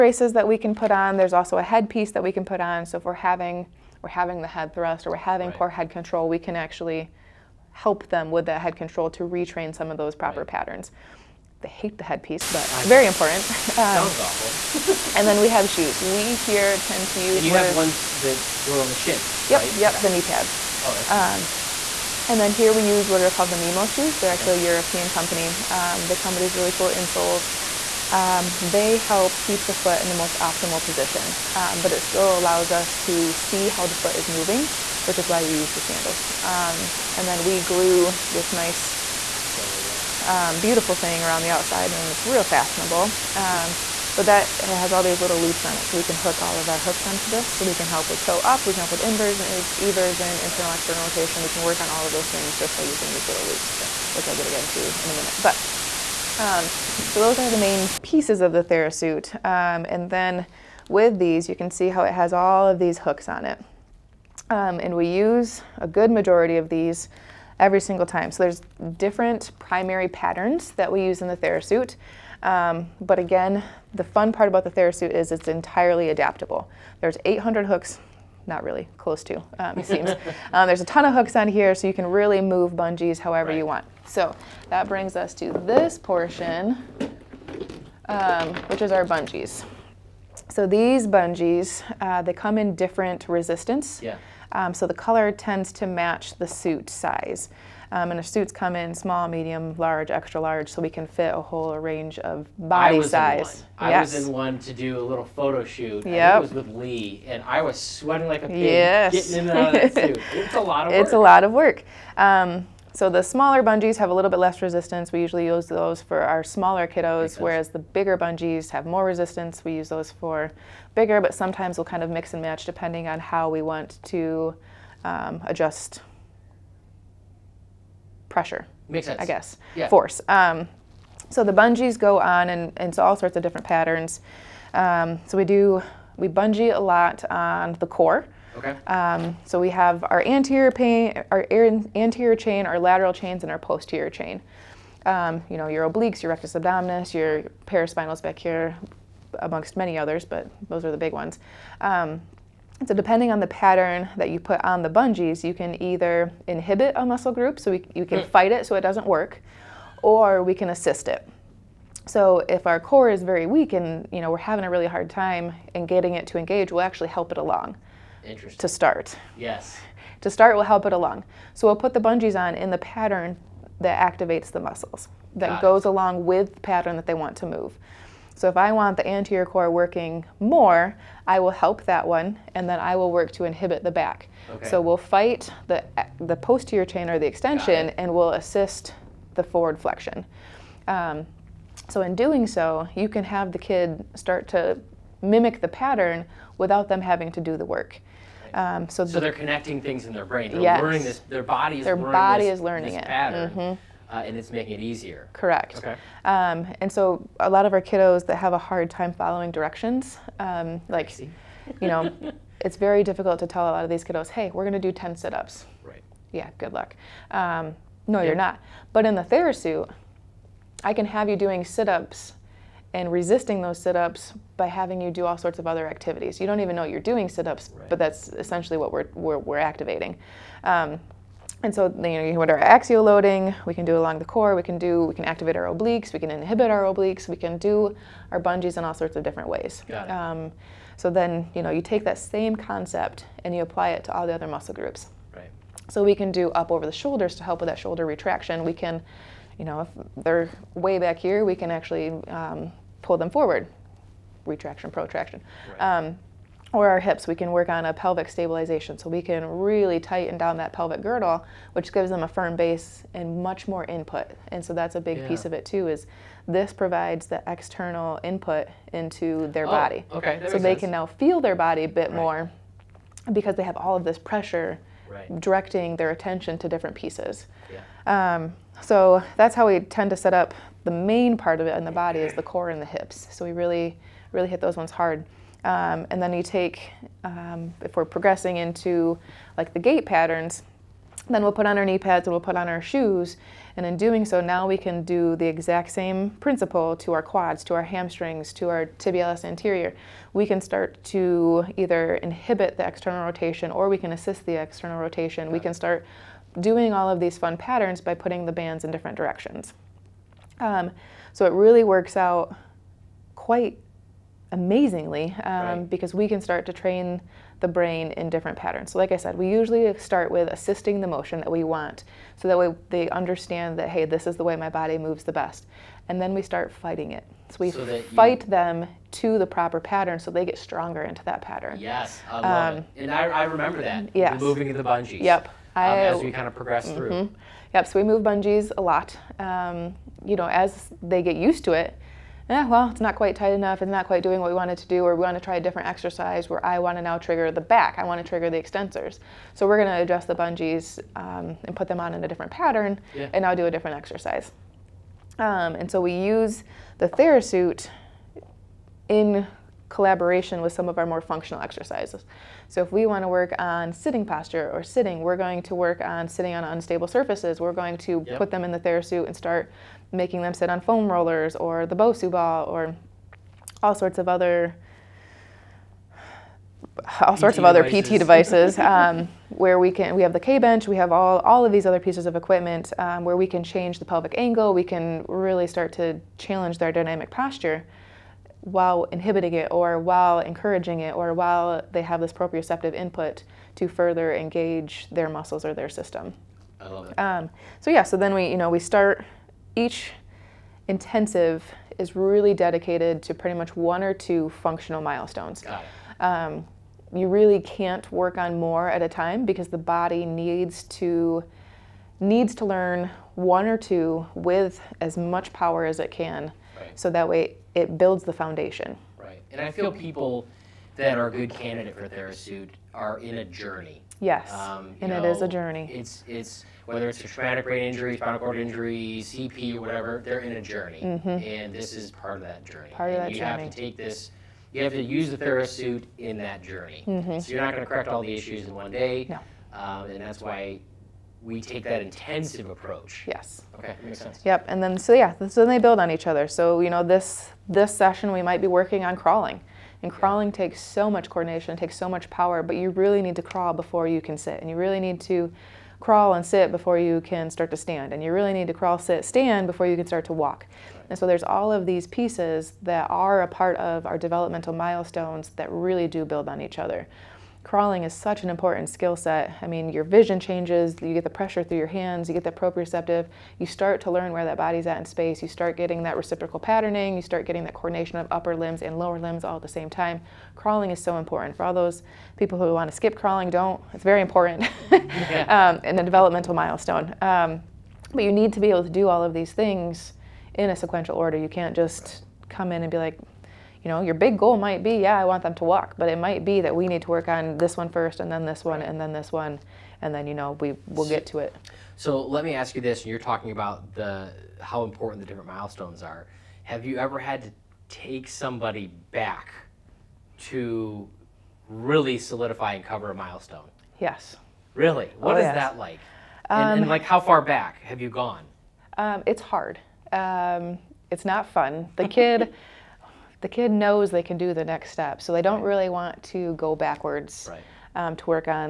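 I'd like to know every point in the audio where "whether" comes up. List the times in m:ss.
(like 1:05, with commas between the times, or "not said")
7:06.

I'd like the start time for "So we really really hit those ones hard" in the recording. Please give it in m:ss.
4:43.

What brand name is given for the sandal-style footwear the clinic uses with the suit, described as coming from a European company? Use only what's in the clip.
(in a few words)
Mimo.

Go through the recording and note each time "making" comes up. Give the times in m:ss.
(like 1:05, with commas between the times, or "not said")
3:24, 6:10.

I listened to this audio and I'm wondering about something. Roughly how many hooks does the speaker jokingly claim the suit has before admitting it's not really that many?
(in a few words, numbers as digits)
800.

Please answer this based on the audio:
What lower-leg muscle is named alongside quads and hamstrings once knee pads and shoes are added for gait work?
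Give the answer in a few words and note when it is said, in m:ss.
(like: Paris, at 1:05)
tibialis anterior, at 4:58.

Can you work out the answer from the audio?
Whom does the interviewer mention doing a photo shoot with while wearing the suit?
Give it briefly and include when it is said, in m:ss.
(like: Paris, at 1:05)
Lee, at 1:46.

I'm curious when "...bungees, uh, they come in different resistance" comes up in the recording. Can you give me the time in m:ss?
1:31.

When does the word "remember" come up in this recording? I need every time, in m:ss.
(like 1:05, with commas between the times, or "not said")
5:33.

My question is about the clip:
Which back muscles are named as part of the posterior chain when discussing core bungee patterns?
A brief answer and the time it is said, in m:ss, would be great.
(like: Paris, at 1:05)
paraspinals, at 2:27.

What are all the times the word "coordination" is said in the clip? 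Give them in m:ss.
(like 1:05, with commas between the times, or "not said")
7:31, 7:57.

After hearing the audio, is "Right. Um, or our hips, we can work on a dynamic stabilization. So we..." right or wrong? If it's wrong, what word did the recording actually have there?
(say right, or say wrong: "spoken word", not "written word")
wrong: "pelvic", not "dynamic".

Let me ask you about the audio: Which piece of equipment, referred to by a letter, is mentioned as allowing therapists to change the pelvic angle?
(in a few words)
K bench.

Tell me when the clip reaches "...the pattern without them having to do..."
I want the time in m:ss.
3:15.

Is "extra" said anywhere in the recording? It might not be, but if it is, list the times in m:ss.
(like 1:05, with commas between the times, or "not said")
1:40.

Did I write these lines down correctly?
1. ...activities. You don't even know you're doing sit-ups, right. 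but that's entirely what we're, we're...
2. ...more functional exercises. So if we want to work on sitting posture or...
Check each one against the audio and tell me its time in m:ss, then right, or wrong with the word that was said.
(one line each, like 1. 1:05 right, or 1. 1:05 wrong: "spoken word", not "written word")
1. 3:45 wrong: "essentially", not "entirely"
2. 6:01 right.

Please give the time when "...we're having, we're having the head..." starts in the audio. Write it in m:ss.
0:03.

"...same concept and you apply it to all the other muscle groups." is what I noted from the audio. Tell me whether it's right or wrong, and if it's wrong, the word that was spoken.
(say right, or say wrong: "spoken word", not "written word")
right.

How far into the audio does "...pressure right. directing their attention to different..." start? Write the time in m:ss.
4:34.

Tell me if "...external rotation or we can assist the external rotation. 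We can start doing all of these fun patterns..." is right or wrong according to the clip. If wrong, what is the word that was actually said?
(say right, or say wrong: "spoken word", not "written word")
right.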